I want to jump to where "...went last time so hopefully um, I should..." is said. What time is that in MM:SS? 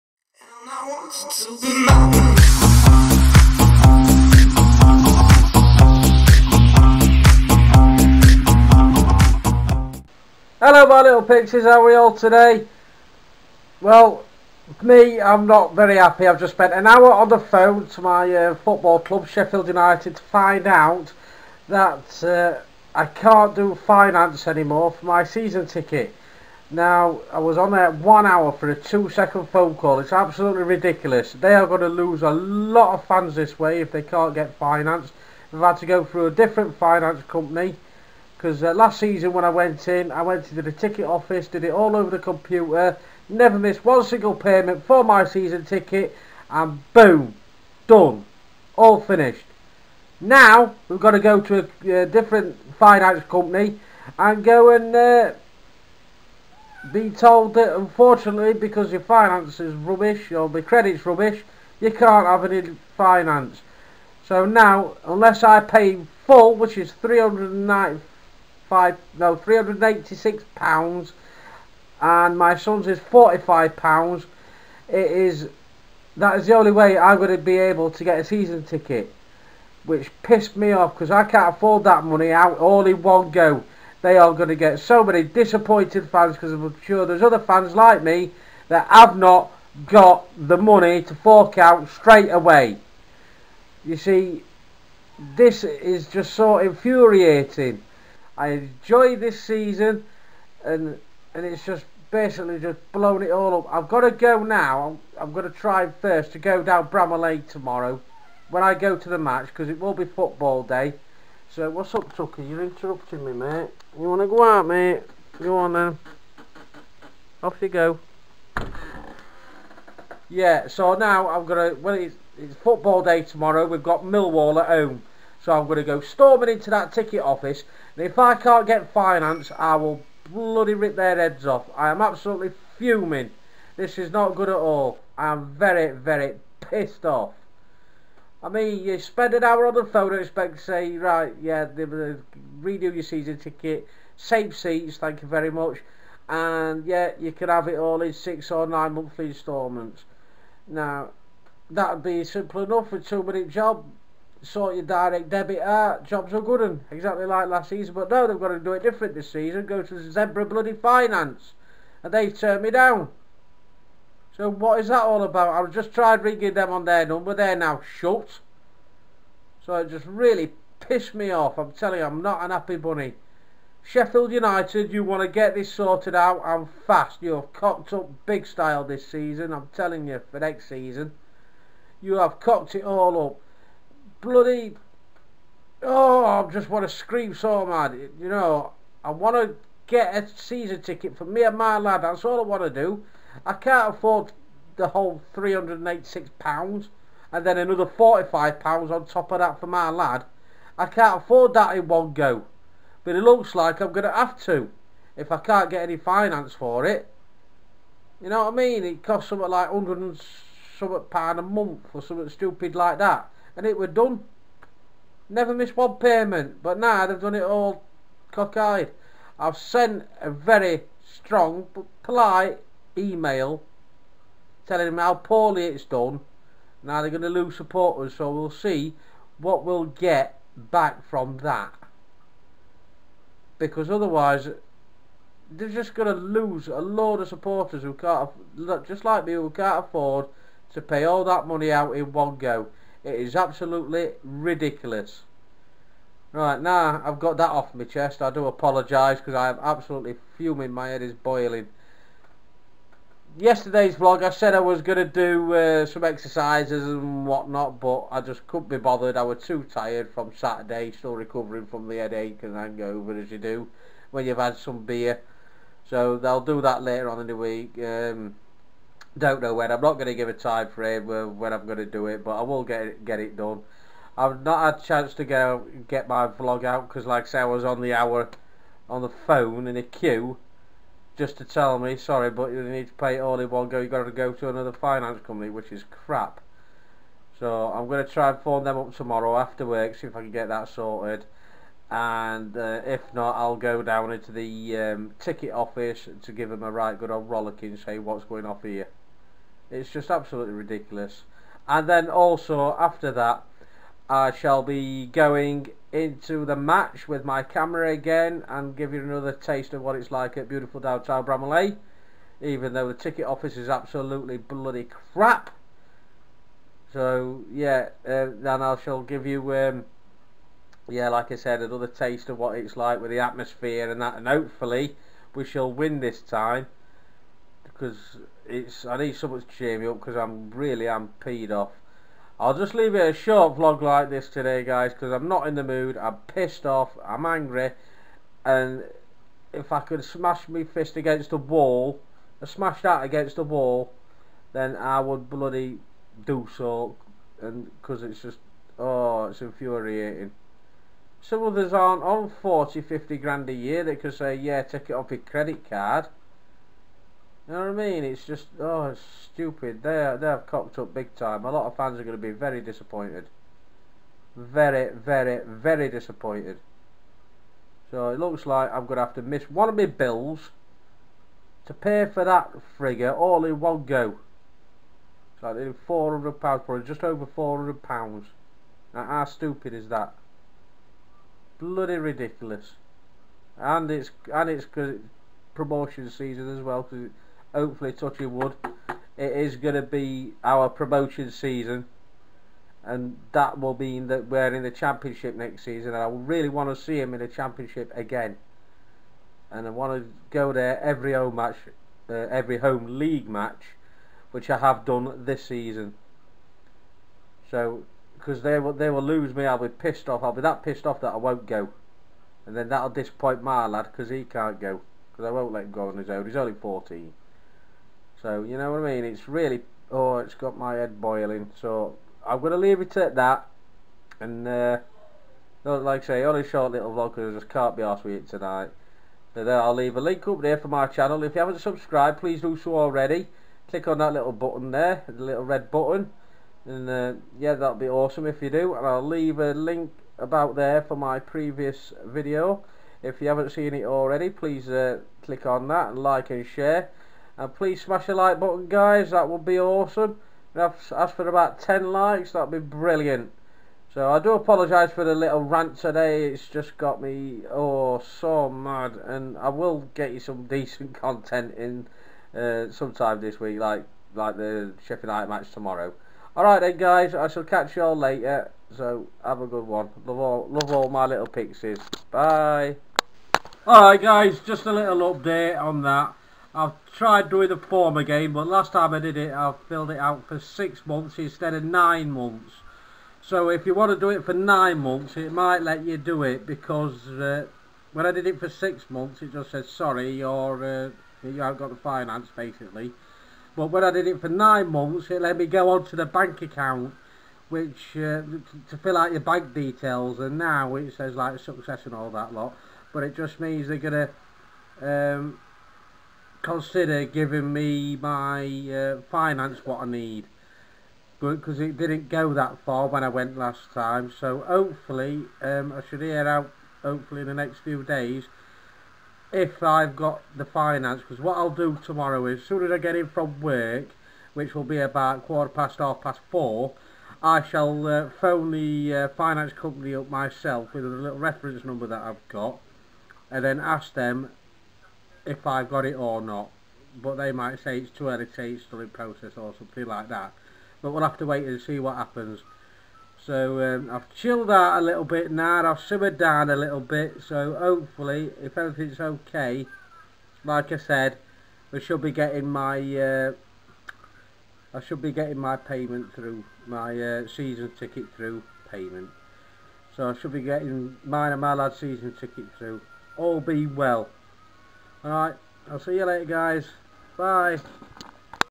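08:33.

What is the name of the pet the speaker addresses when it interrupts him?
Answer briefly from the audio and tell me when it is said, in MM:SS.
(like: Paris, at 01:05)
Tucker, at 01:52.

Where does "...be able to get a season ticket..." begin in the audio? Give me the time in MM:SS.
01:17.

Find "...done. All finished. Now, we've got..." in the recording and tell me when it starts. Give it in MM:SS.
00:47.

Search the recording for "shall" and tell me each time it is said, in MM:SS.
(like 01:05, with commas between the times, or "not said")
05:04, 05:18, 05:25, 07:47, 08:47.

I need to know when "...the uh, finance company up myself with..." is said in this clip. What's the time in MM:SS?
08:48.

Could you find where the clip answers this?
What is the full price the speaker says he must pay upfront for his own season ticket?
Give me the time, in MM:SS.
01:09.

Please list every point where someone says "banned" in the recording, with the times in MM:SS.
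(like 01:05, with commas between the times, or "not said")
not said.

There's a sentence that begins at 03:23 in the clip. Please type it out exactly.
But it looks like I'm going to have to if I can't get any finance for it.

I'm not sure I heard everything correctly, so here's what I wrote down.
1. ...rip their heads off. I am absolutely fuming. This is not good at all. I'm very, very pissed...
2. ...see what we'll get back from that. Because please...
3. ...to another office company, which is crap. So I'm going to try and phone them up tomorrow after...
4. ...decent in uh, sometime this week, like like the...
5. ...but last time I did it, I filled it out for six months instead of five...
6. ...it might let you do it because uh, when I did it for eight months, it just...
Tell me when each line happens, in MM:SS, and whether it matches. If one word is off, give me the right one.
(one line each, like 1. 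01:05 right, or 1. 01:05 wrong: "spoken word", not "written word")
1. 02:10 right
2. 03:48 wrong: "otherwise", not "please"
3. 04:44 wrong: "finance", not "office"
4. 07:40 wrong: "content", not "decent"
5. 07:58 wrong: "nine", not "five"
6. 08:05 wrong: "six", not "eight".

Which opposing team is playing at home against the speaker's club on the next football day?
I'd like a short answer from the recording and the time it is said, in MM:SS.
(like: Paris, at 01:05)
Millwall, at 02:04.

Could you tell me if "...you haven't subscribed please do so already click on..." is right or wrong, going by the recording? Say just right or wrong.
right.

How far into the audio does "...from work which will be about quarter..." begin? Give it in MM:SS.
08:43.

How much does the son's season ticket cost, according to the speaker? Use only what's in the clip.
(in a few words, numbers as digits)
£45.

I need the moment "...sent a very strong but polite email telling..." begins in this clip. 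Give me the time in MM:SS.
03:39.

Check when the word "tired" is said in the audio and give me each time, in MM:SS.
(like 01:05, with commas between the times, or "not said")
04:19.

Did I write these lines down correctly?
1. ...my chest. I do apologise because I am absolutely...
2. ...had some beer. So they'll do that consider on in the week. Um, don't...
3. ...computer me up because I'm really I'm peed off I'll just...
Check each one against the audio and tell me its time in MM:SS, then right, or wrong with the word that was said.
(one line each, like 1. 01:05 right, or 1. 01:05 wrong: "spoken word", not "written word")
1. 04:07 right
2. 04:24 wrong: "later", not "consider"
3. 05:29 wrong: "cheer", not "computer".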